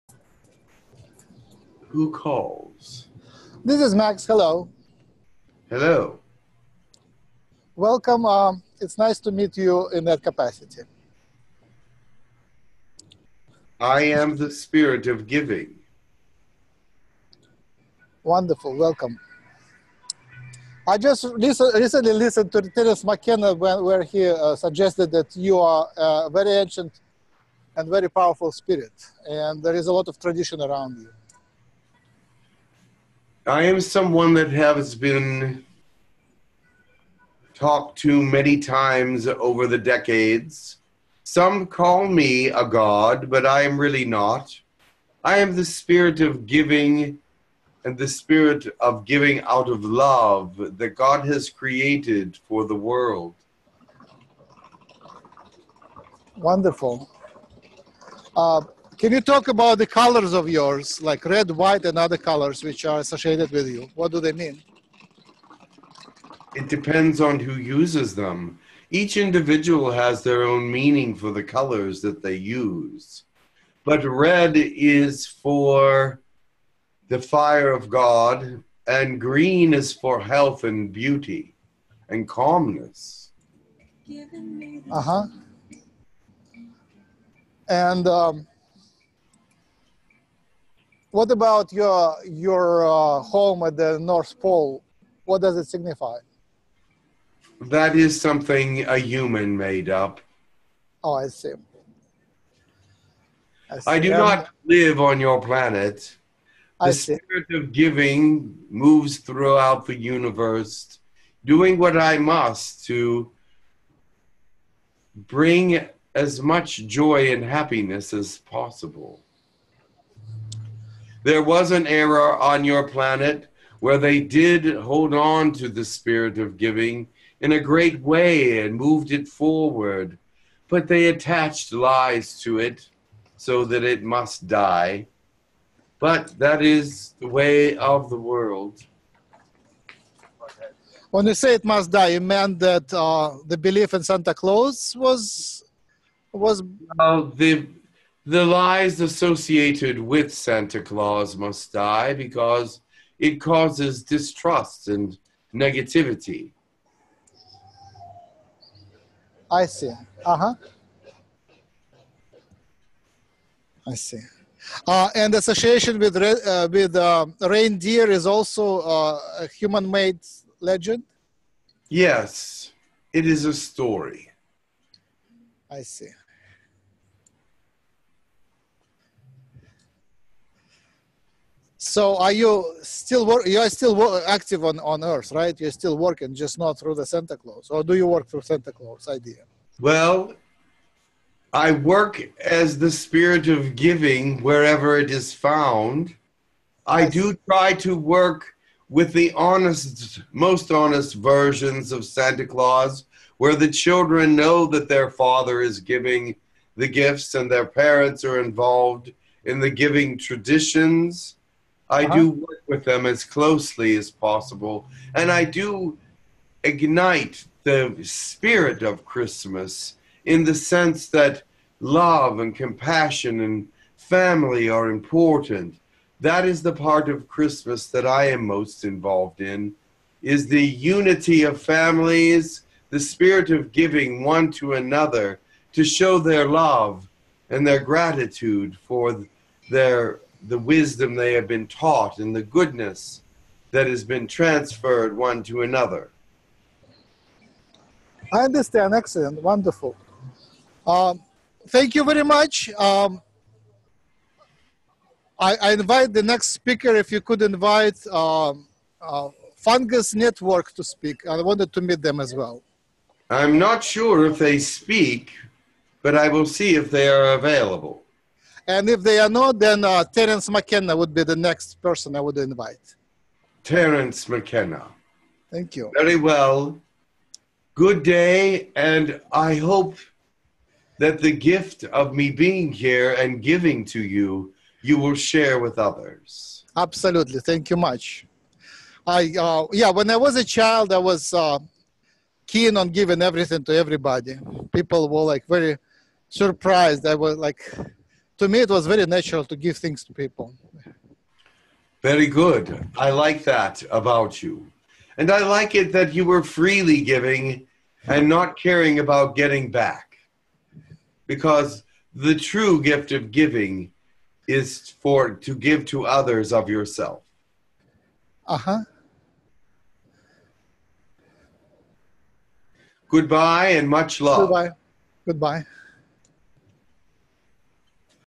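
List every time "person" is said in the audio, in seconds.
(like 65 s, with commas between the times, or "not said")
271 s.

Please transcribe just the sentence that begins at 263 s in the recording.
I'm not sure if they speak, but I will see if they are available.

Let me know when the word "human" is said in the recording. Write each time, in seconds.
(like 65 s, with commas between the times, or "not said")
98 s, 169 s.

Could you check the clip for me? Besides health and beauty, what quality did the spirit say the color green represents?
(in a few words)
Calmness.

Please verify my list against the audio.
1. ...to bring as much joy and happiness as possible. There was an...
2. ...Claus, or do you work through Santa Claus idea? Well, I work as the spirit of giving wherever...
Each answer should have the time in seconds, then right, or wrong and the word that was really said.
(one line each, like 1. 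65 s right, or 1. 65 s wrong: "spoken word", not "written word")
1. 112 s right
2. 187 s right.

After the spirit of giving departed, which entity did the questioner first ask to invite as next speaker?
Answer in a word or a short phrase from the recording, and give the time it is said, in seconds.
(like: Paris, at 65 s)
Fungus Network, at 259 s.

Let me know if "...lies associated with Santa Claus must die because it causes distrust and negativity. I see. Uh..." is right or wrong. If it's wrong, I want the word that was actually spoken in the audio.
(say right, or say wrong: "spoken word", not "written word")
right.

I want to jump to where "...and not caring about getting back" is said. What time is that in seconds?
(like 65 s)
308 s.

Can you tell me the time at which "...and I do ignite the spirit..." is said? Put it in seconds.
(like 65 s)
215 s.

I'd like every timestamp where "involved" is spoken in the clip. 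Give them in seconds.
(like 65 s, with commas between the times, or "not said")
208 s, 228 s.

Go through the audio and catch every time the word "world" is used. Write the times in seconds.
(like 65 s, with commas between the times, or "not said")
52 s, 138 s.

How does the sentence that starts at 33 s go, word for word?
I am someone that has been talked to many times over the decades.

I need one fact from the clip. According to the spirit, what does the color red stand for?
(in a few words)
The fire of God.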